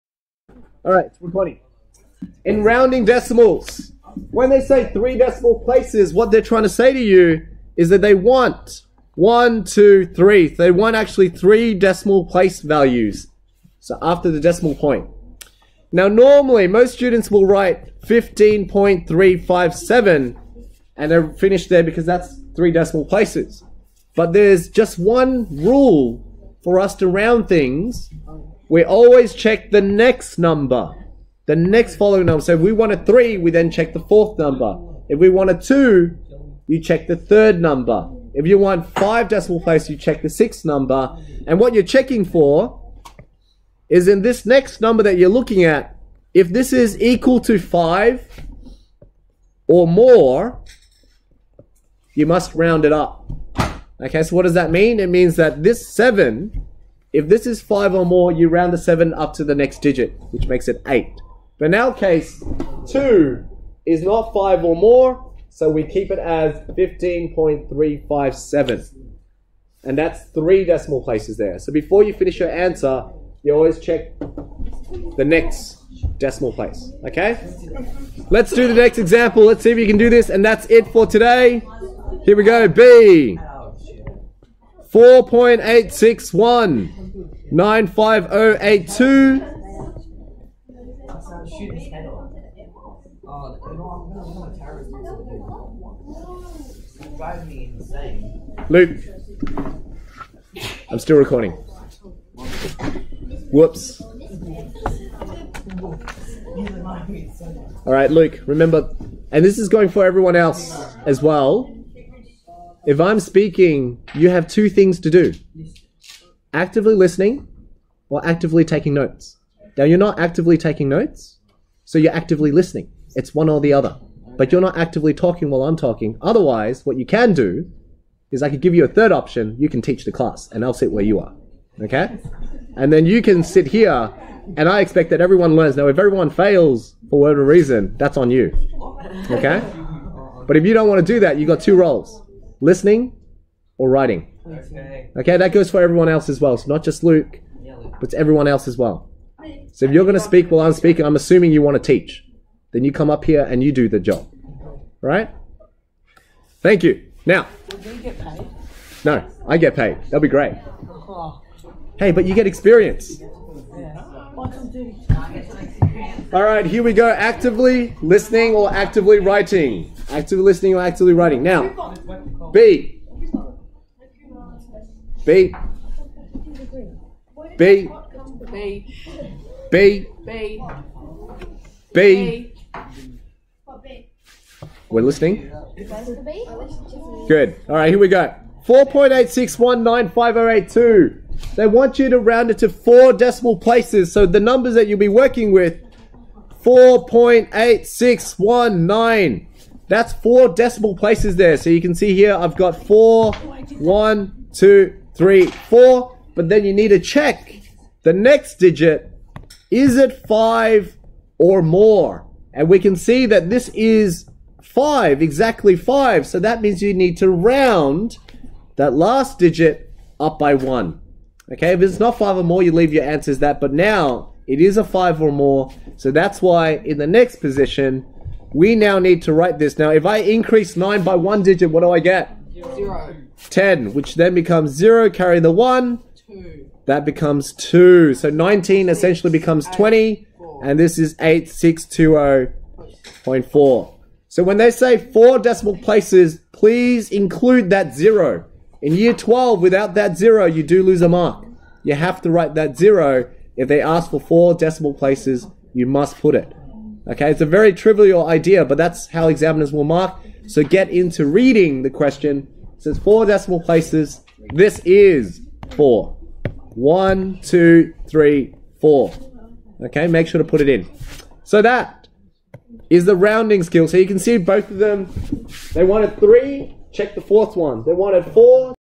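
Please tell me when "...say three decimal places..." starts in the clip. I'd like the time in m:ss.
0:04.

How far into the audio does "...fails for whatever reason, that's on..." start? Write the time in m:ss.
2:16.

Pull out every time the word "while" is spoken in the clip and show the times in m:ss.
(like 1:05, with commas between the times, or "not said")
2:05, 2:30.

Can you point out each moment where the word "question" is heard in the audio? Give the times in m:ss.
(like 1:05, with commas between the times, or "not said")
4:21.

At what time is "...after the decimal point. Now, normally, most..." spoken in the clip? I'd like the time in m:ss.
0:14.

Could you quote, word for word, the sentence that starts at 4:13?
If they ask for four decimal places, you must put it.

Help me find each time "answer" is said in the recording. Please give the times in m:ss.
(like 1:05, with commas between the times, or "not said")
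1:12, 3:43.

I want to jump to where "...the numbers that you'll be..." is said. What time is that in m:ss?
3:14.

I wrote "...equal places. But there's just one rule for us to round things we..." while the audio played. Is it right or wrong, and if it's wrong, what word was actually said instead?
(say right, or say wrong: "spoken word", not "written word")
wrong: "decimal", not "equal".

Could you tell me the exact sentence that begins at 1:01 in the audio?
But in our case, 2 is not 5 or more, so we keep it as 15.357.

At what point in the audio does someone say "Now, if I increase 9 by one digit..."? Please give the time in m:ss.
3:49.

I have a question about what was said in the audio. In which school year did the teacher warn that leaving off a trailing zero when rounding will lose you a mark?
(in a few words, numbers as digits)
Year 12.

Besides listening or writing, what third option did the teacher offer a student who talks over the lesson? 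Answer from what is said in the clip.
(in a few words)
Teach the class.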